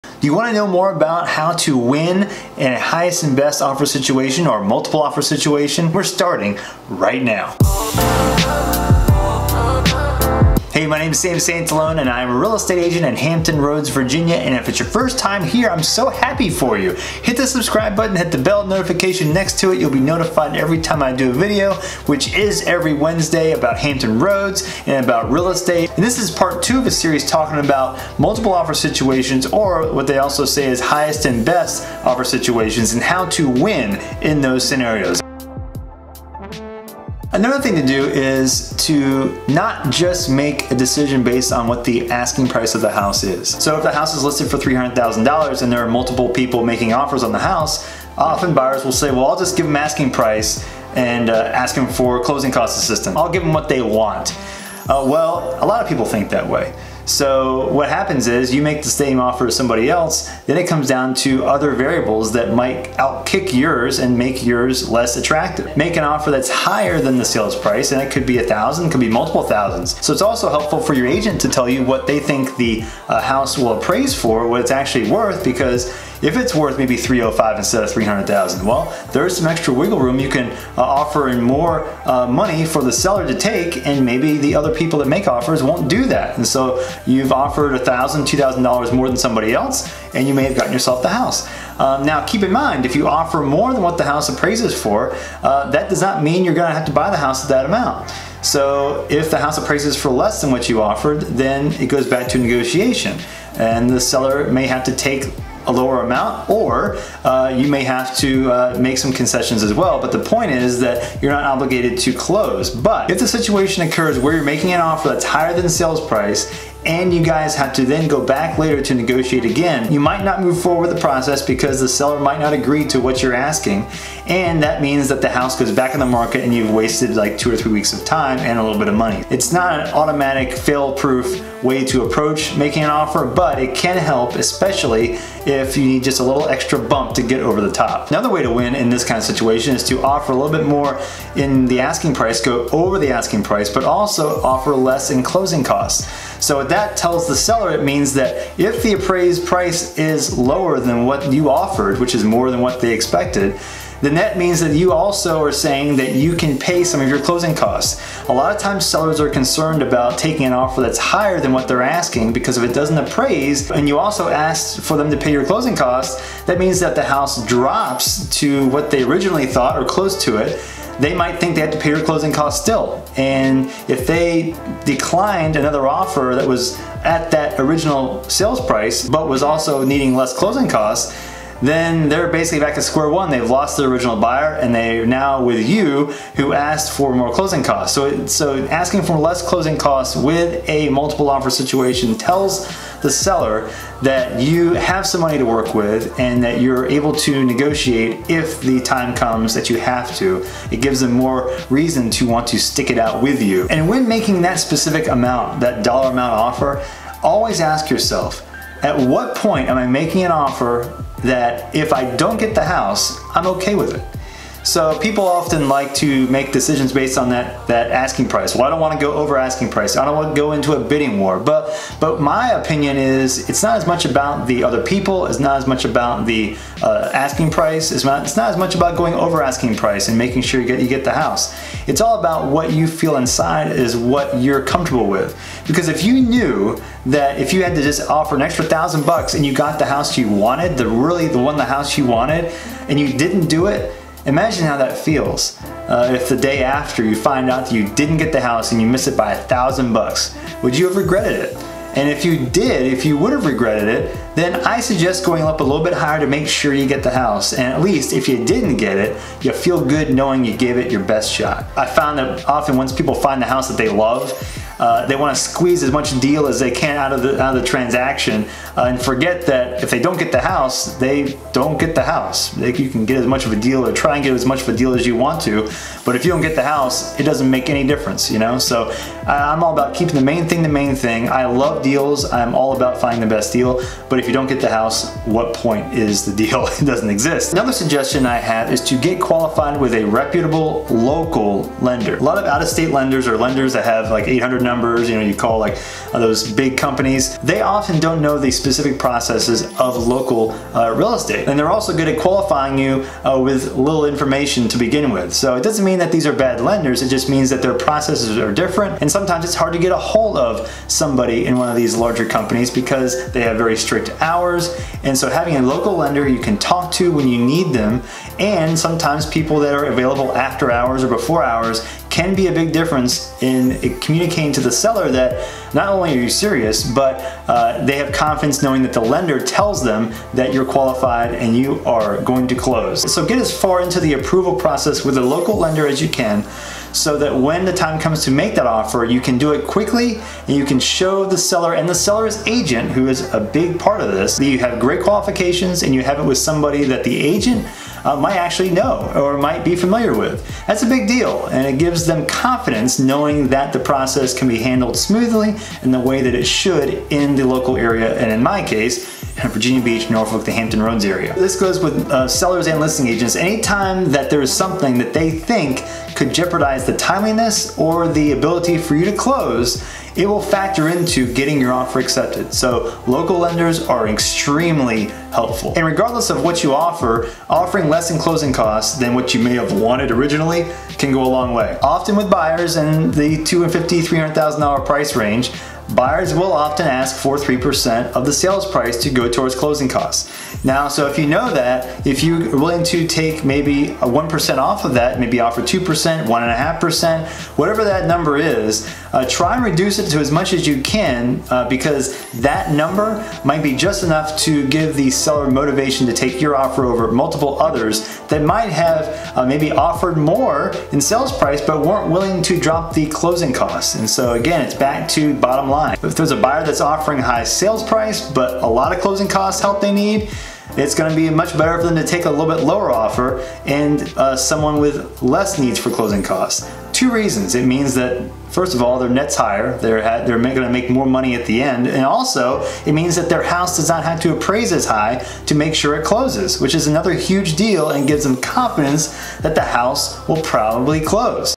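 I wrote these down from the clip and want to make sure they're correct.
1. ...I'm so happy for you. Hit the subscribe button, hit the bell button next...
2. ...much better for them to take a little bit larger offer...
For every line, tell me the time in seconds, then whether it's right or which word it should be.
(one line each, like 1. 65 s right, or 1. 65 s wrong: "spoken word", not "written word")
1. 15 s wrong: "notification", not "button"
2. 421 s wrong: "lower", not "larger".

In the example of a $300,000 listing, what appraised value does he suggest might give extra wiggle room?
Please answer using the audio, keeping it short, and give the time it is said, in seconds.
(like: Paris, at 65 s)
305, at 76 s.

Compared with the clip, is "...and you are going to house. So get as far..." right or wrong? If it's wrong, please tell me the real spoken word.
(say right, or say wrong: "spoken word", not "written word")
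wrong: "close", not "house".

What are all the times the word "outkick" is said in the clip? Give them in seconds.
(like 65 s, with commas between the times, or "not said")
62 s.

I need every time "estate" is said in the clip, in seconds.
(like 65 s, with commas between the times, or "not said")
12 s, 25 s, 301 s.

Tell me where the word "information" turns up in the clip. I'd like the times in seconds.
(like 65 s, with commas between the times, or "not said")
304 s.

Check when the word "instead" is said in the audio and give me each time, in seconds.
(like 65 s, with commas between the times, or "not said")
77 s.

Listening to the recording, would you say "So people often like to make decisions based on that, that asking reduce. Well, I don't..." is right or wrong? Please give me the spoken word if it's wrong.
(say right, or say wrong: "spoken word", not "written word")
wrong: "price", not "reduce".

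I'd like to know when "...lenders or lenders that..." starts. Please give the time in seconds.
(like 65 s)
292 s.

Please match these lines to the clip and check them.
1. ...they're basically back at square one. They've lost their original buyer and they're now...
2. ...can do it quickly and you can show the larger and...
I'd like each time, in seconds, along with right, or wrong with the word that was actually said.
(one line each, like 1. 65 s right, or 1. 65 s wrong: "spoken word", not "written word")
1. 182 s right
2. 339 s wrong: "seller", not "larger".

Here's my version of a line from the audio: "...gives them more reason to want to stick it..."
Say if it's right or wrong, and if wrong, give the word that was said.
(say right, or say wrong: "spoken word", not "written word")
right.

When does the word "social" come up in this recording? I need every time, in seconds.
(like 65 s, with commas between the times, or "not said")
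not said.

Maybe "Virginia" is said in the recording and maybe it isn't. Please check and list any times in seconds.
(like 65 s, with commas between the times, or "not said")
13 s, 359 s.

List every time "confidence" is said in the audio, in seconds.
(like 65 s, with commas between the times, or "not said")
328 s, 352 s, 438 s.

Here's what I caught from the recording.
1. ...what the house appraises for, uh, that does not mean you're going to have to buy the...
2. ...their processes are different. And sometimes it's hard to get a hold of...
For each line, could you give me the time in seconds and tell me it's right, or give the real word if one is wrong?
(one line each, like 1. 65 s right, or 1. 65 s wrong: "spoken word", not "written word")
1. 93 s right
2. 307 s right.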